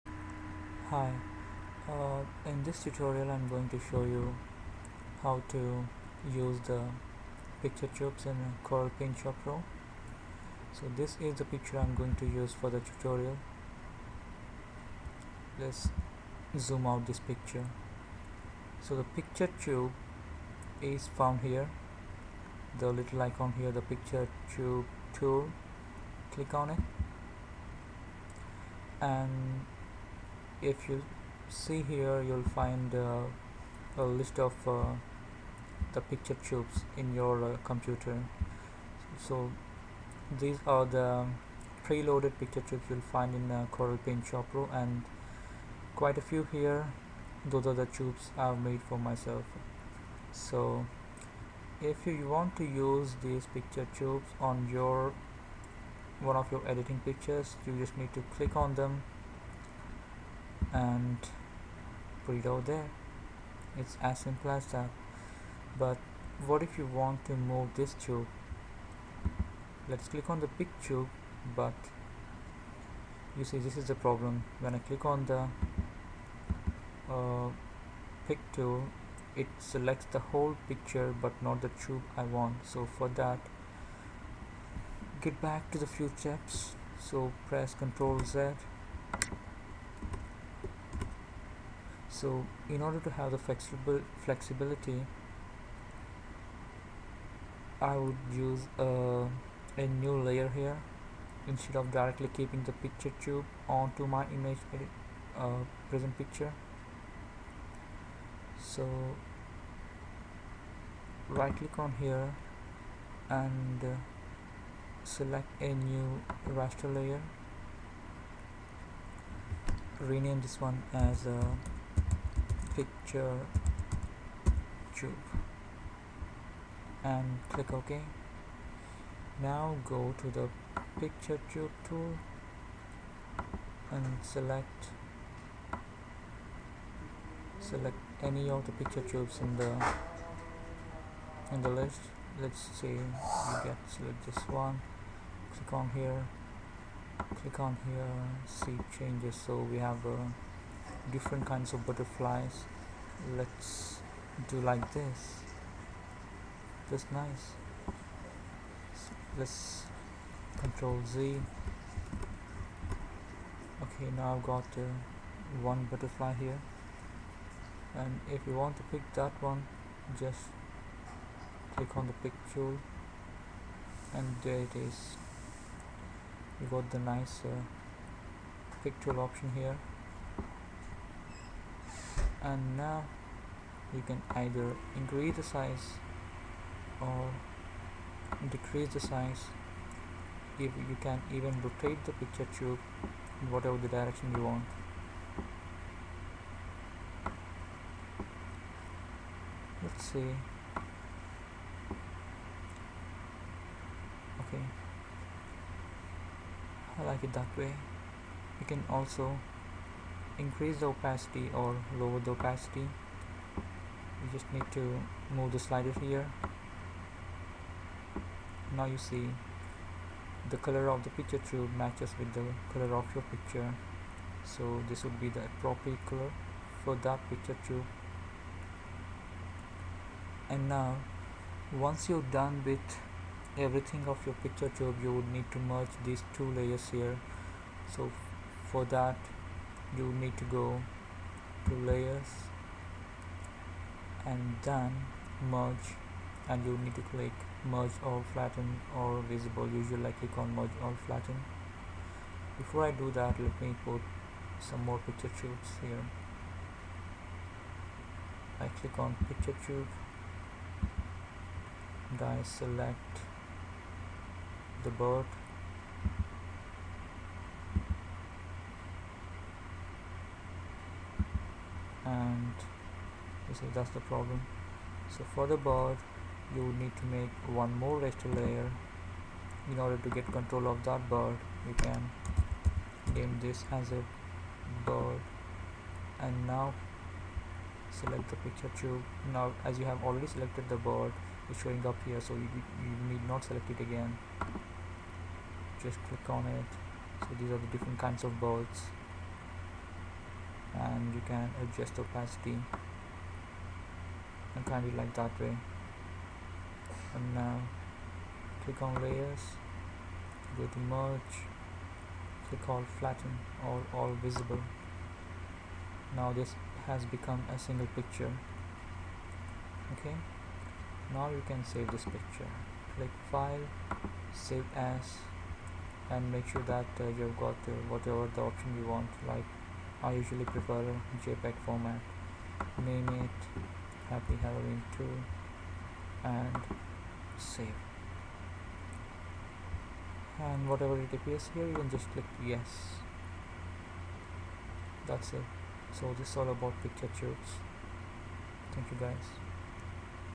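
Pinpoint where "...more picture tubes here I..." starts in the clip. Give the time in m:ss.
4:14.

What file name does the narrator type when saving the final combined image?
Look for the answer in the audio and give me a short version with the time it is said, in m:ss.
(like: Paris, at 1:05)
Happy Halloween 2, at 5:34.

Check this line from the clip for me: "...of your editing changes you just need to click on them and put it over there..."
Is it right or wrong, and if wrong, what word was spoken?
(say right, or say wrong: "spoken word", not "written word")
wrong: "pictures", not "changes".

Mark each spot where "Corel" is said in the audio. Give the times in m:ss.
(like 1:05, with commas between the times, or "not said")
0:08, 0:43.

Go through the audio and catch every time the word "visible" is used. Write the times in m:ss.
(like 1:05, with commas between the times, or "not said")
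4:09, 5:14.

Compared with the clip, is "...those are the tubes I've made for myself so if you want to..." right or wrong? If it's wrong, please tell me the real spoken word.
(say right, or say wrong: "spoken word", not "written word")
right.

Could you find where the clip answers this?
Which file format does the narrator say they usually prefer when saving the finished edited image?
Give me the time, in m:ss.
5:31.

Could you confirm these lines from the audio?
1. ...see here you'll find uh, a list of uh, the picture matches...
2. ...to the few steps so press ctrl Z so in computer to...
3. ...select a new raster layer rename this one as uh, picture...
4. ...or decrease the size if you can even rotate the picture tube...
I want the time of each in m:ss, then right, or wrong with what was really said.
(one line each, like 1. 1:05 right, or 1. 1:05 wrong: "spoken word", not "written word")
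1. 0:31 wrong: "tubes", not "matches"
2. 1:25 wrong: "order", not "computer"
3. 1:55 right
4. 3:06 right.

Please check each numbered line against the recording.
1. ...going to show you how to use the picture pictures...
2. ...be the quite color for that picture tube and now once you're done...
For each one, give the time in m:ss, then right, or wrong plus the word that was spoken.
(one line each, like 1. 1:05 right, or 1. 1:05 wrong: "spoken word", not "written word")
1. 0:03 wrong: "tubes", not "pictures"
2. 3:45 wrong: "appropriate", not "quite".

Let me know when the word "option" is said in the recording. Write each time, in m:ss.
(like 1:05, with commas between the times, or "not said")
2:59, 5:28.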